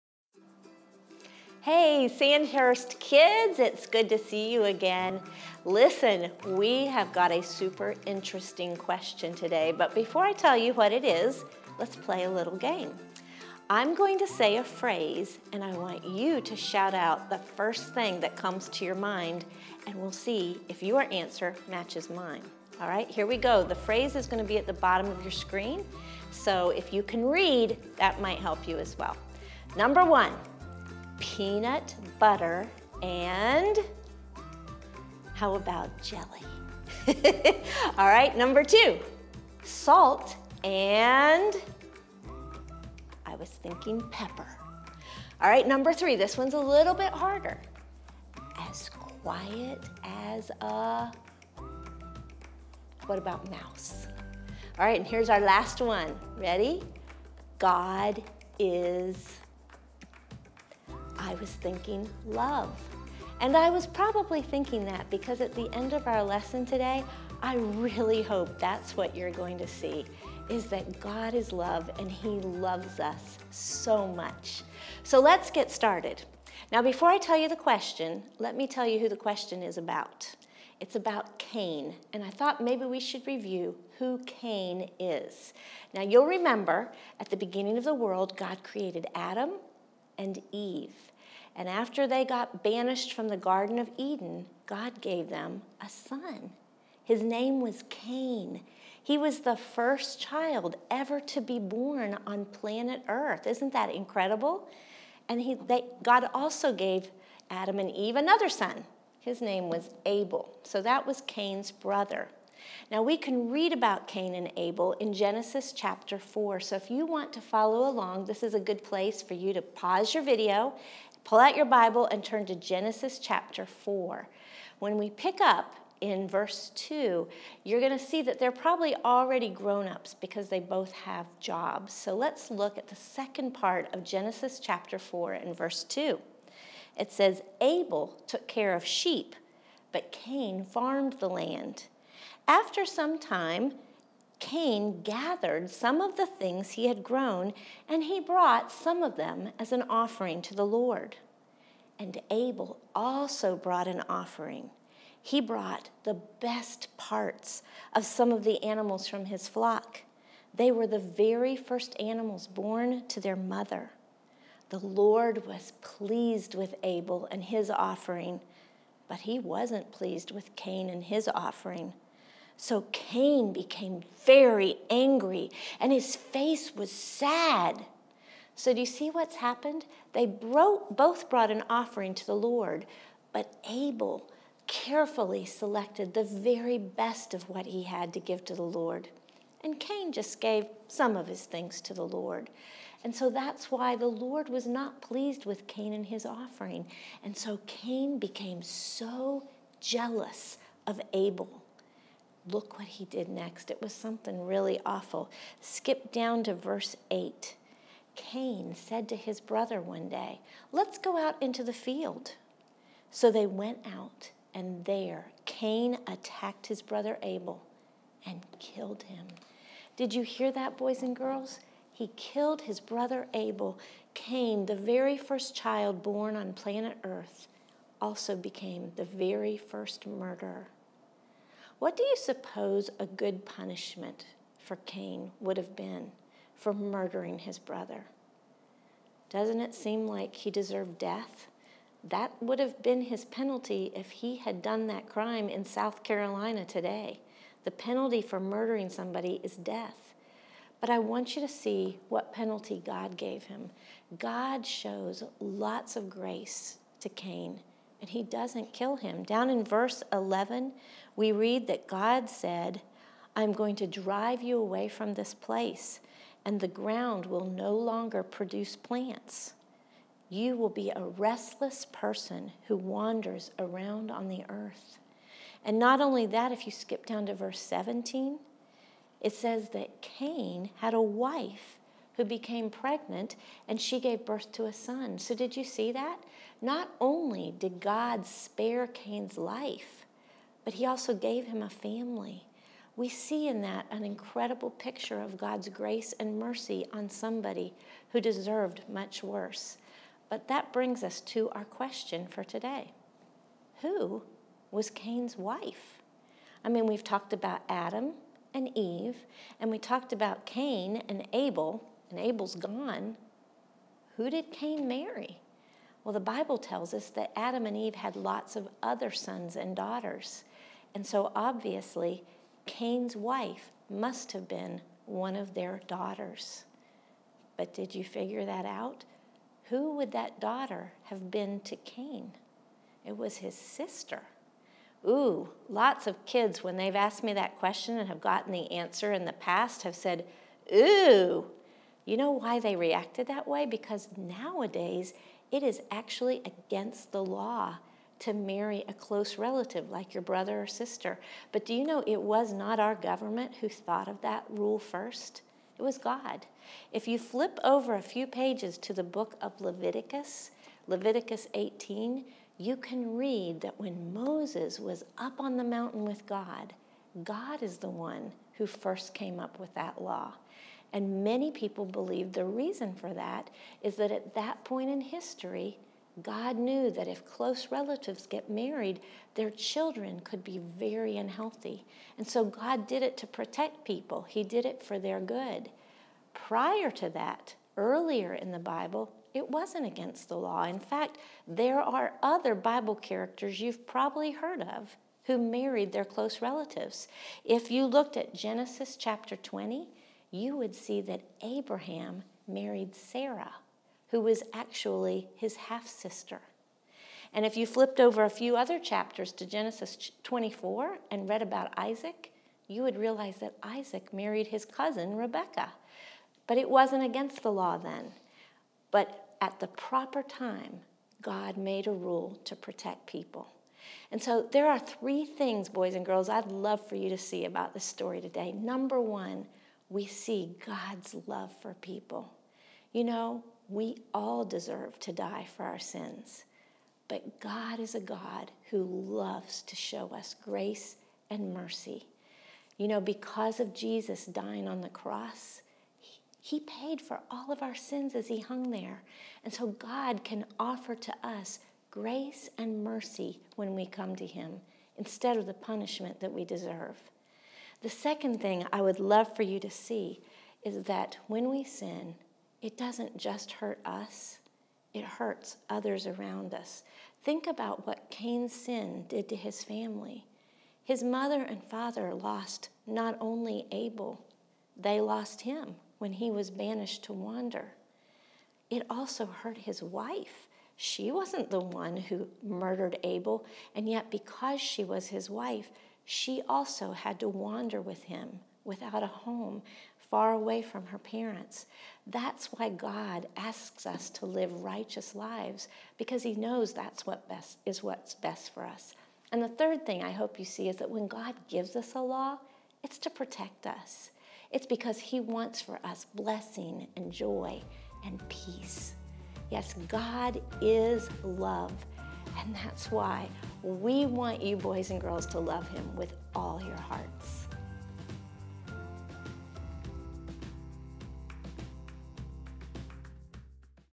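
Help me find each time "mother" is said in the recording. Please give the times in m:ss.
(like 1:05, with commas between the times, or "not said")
2:43, 7:51.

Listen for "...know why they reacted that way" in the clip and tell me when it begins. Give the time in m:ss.
5:42.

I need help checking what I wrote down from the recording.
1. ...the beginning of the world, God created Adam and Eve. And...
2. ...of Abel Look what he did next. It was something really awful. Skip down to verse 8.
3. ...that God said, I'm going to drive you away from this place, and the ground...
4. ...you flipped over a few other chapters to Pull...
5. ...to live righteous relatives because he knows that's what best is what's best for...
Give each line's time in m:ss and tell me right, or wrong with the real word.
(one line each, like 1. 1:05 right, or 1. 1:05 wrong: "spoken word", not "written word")
1. 1:27 right
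2. 3:20 right
3. 4:21 right
4. 6:47 wrong: "Genesis", not "Pull"
5. 8:14 wrong: "lives", not "relatives".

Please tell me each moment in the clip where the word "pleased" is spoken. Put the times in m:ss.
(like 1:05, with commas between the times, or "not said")
2:45, 2:49, 3:15.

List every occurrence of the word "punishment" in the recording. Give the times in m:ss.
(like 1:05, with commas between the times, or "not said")
3:53, 7:35.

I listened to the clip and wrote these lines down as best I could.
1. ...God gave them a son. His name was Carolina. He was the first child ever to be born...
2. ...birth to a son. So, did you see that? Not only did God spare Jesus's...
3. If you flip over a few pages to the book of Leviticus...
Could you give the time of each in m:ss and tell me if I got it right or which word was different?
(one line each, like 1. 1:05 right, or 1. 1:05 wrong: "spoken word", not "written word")
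1. 1:34 wrong: "Cain", not "Carolina"
2. 4:44 wrong: "Cain", not "Jesus"
3. 5:56 right.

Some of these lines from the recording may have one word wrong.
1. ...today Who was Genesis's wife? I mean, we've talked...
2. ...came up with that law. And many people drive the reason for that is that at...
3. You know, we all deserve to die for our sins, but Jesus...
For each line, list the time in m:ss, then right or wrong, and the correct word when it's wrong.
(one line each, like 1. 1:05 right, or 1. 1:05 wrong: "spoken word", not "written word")
1. 5:02 wrong: "Cain", not "Genesis"
2. 6:09 wrong: "believe", not "drive"
3. 7:12 wrong: "God", not "Jesus".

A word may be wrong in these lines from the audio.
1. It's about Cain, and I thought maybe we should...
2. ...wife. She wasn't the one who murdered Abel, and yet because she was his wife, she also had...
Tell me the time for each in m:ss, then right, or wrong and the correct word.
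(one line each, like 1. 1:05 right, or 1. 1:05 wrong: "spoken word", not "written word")
1. 1:20 right
2. 7:59 right.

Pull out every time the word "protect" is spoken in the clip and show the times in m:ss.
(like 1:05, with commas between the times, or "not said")
6:23, 7:02, 8:23.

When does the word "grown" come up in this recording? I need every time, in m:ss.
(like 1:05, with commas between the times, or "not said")
2:09, 2:27.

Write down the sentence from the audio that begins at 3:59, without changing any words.
Doesn't it seem like he deserved death?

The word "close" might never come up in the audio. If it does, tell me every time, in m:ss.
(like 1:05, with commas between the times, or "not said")
5:48, 6:17, 6:36.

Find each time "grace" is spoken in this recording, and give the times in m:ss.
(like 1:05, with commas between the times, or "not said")
4:16, 4:55, 7:20, 7:31.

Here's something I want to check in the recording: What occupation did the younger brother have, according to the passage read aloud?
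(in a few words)
took care of sheep.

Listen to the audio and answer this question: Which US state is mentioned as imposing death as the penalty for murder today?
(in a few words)
South Carolina.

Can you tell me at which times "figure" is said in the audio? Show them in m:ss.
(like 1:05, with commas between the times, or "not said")
5:28.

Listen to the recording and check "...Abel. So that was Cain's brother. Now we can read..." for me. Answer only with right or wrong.
right.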